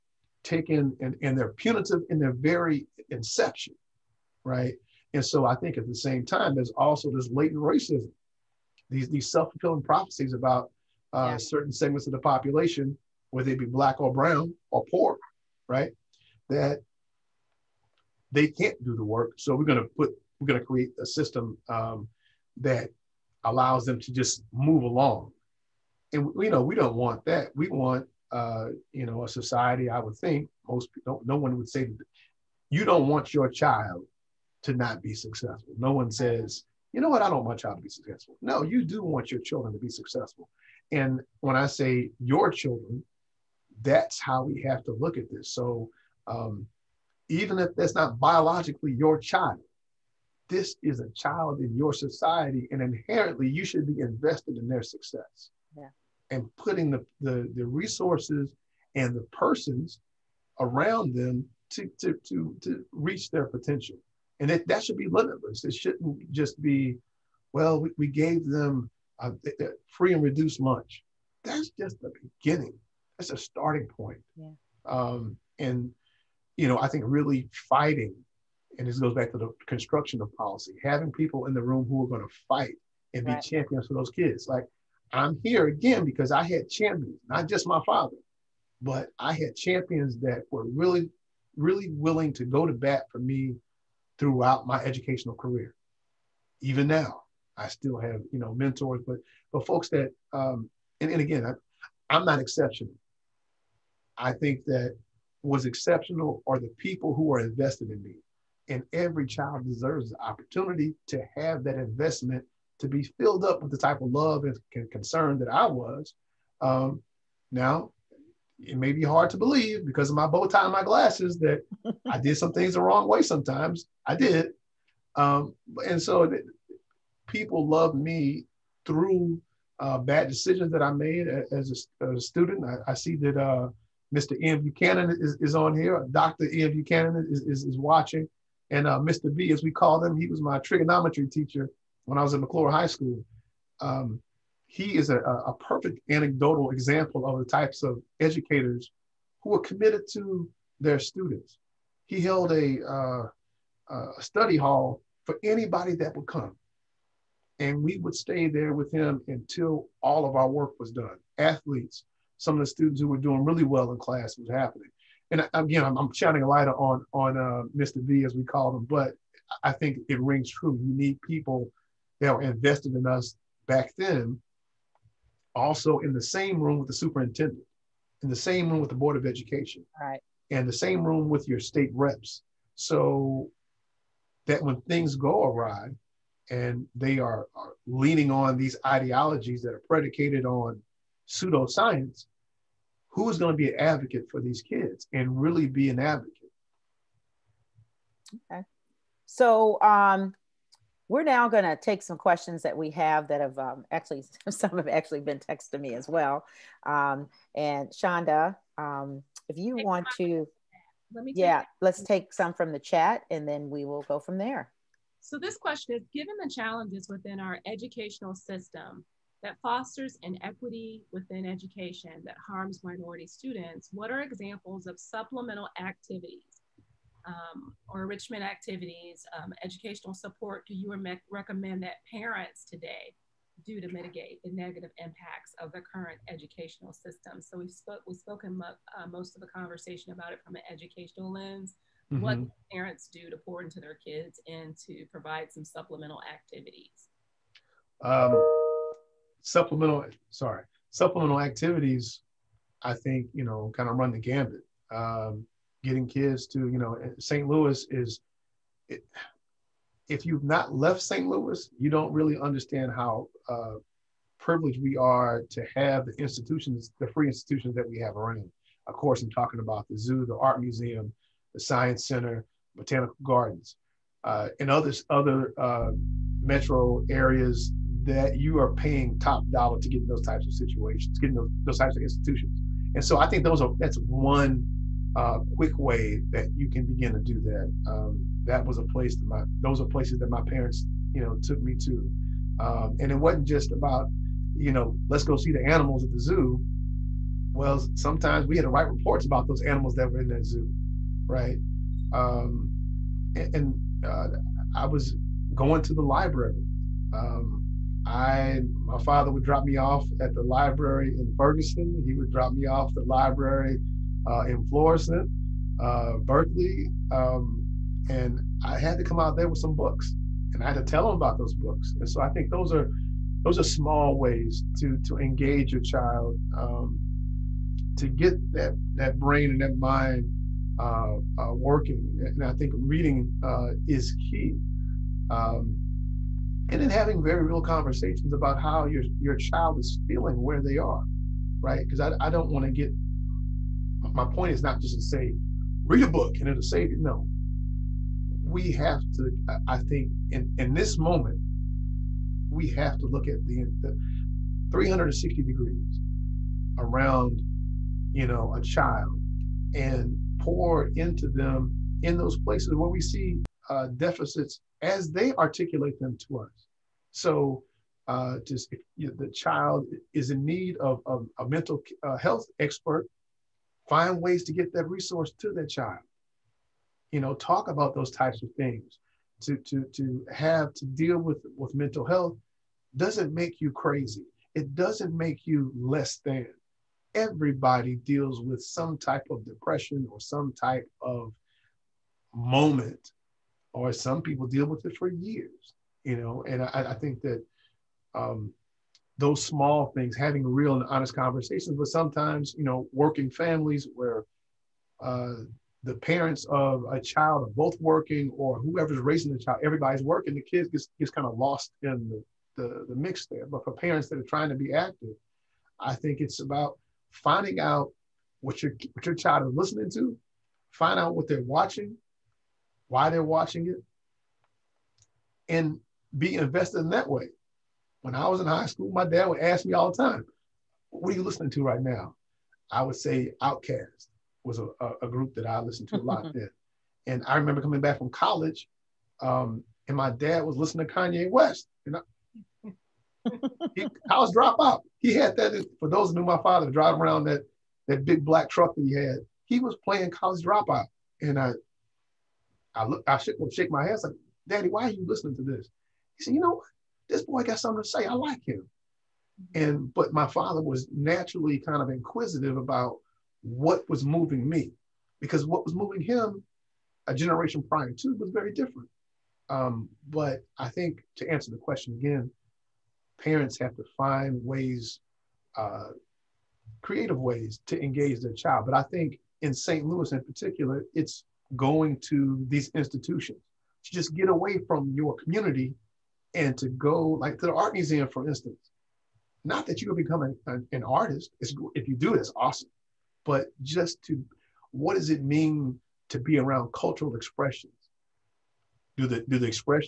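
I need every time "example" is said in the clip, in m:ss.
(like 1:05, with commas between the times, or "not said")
2:26, 3:44.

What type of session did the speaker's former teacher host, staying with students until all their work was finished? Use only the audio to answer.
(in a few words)
a study hall.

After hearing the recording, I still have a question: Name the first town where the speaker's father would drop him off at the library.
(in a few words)
Ferguson.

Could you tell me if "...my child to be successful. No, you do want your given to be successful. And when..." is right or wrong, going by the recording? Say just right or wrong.
wrong.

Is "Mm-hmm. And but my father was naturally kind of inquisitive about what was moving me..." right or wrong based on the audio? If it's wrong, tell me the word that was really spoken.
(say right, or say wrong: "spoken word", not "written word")
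right.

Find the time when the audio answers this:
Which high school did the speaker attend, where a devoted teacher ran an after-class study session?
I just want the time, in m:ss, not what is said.
2:22.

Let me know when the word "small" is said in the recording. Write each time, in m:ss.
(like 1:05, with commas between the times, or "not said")
5:23, 6:39.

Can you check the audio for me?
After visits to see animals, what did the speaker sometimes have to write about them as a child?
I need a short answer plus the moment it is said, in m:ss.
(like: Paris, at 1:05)
reports, at 4:58.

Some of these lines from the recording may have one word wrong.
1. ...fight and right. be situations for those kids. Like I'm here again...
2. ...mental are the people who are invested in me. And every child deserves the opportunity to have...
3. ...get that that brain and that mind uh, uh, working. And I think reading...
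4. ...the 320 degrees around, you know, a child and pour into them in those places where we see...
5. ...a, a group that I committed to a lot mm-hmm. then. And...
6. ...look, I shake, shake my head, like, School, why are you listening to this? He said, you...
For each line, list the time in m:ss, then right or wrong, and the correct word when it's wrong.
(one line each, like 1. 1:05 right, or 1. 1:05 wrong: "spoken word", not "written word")
1. 1:22 wrong: "champions", not "situations"
2. 1:45 wrong: "exceptional", not "mental"
3. 5:28 right
4. 5:53 wrong: "360", not "320"
5. 7:14 wrong: "listened", not "committed"
6. 7:32 wrong: "Daddy", not "School".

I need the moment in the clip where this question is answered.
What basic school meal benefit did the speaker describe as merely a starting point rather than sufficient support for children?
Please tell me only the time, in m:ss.
1:09.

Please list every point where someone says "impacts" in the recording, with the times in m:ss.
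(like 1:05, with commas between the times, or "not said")
3:54.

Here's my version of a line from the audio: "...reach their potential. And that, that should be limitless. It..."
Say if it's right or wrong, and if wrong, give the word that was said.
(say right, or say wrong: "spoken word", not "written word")
right.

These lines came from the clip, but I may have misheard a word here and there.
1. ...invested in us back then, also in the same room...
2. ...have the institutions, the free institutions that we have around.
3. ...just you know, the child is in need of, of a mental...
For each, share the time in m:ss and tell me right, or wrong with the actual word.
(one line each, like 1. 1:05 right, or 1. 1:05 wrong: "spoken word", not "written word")
1. 2:52 right
2. 4:25 right
3. 6:08 right.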